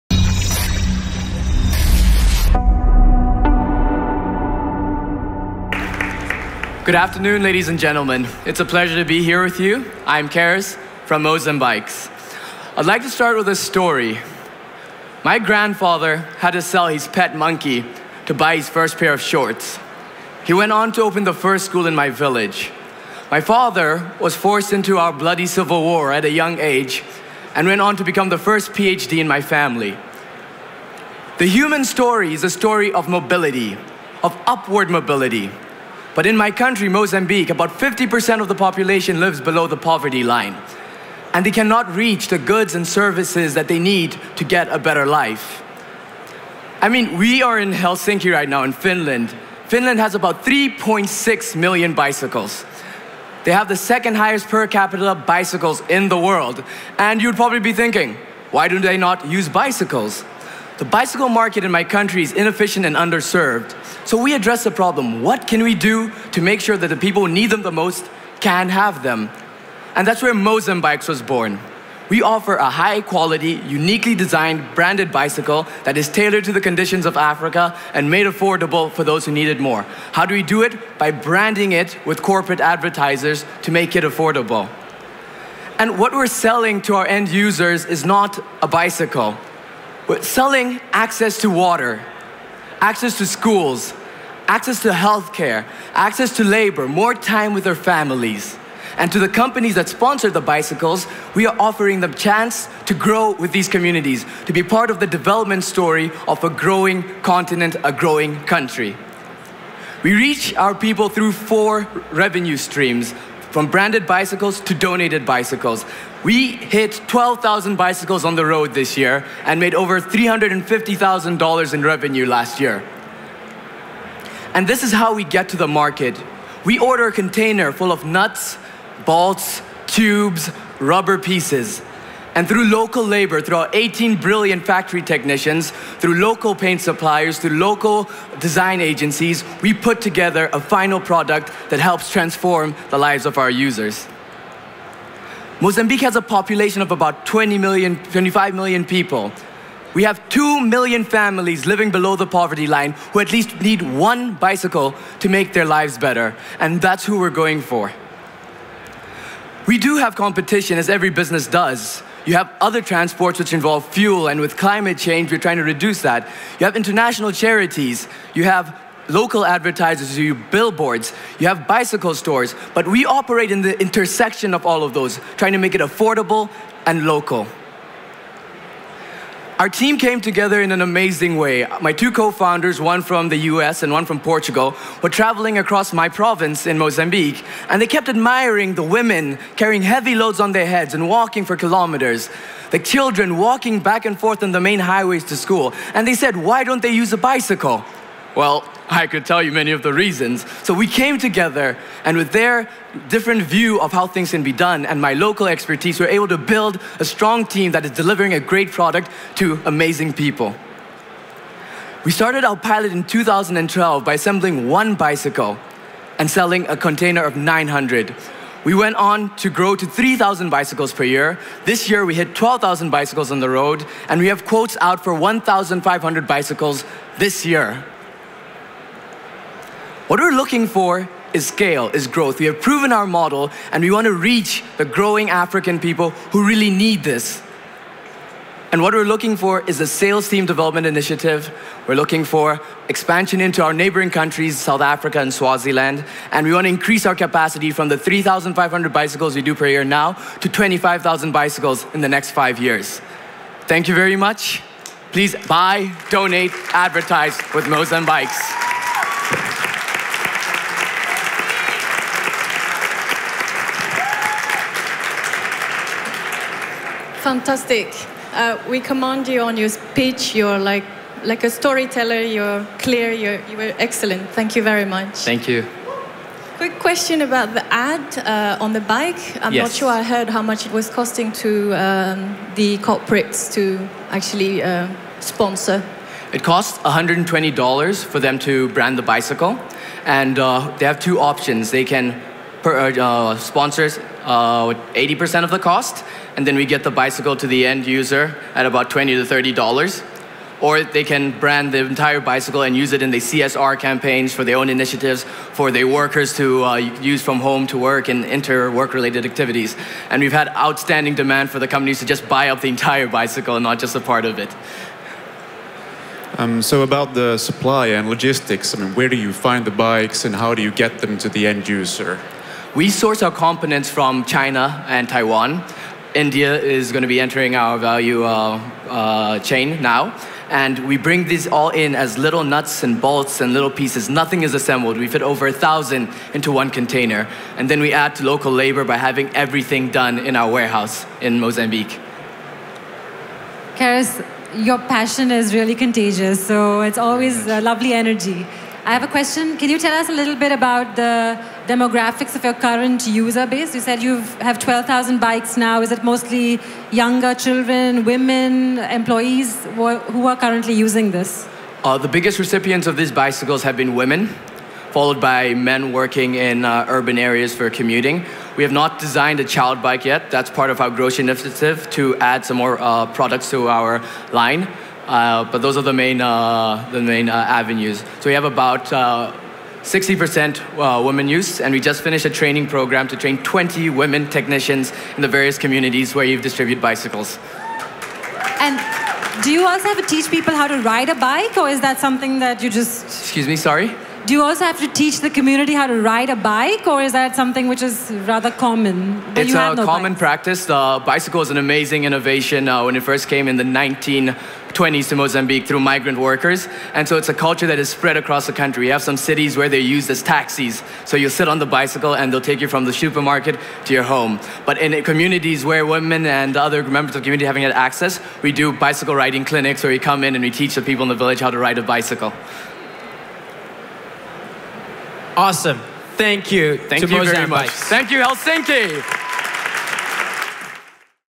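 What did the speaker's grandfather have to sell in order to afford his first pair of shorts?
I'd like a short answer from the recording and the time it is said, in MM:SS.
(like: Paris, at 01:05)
His pet monkey, at 00:16.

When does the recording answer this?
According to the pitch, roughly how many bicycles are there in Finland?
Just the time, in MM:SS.
00:50.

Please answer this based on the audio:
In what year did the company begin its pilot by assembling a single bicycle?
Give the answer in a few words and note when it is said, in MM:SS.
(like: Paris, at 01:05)
2012, at 03:33.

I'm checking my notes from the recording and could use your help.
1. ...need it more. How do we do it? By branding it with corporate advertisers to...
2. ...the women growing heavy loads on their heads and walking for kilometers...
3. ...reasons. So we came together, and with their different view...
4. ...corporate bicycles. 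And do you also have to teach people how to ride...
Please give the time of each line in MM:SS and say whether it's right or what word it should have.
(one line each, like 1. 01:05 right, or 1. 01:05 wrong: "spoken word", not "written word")
1. 01:19 right
2. 03:08 wrong: "carrying", not "growing"
3. 03:19 right
4. 06:26 wrong: "distribute", not "corporate".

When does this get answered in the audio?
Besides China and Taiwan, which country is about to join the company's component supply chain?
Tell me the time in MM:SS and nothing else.
05:26.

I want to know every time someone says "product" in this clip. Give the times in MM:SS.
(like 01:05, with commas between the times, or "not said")
02:21, 03:28, 06:13.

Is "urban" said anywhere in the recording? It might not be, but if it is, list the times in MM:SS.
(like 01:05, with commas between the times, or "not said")
06:06.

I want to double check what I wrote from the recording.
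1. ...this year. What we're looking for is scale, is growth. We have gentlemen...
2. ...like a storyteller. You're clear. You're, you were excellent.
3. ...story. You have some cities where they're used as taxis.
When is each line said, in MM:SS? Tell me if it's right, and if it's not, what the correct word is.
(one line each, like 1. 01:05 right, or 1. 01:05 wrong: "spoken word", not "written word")
1. 03:47 wrong: "proven", not "gentlemen"
2. 04:31 right
3. 06:48 wrong: "country", not "story".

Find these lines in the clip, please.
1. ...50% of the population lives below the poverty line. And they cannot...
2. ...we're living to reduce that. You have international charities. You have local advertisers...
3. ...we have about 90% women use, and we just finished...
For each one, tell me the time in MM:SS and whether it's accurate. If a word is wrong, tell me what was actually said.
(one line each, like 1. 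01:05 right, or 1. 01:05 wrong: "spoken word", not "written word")
1. 00:37 right
2. 02:45 wrong: "trying", not "living"
3. 06:18 wrong: "60", not "90".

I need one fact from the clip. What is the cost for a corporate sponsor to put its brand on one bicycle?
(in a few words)
$120.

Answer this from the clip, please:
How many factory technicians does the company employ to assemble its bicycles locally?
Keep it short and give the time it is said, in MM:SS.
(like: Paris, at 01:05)
18, at 02:13.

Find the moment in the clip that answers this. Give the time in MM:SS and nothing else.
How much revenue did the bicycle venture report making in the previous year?
01:59.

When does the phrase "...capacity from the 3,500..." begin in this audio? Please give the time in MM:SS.
04:07.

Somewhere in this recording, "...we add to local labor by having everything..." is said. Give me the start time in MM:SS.
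05:37.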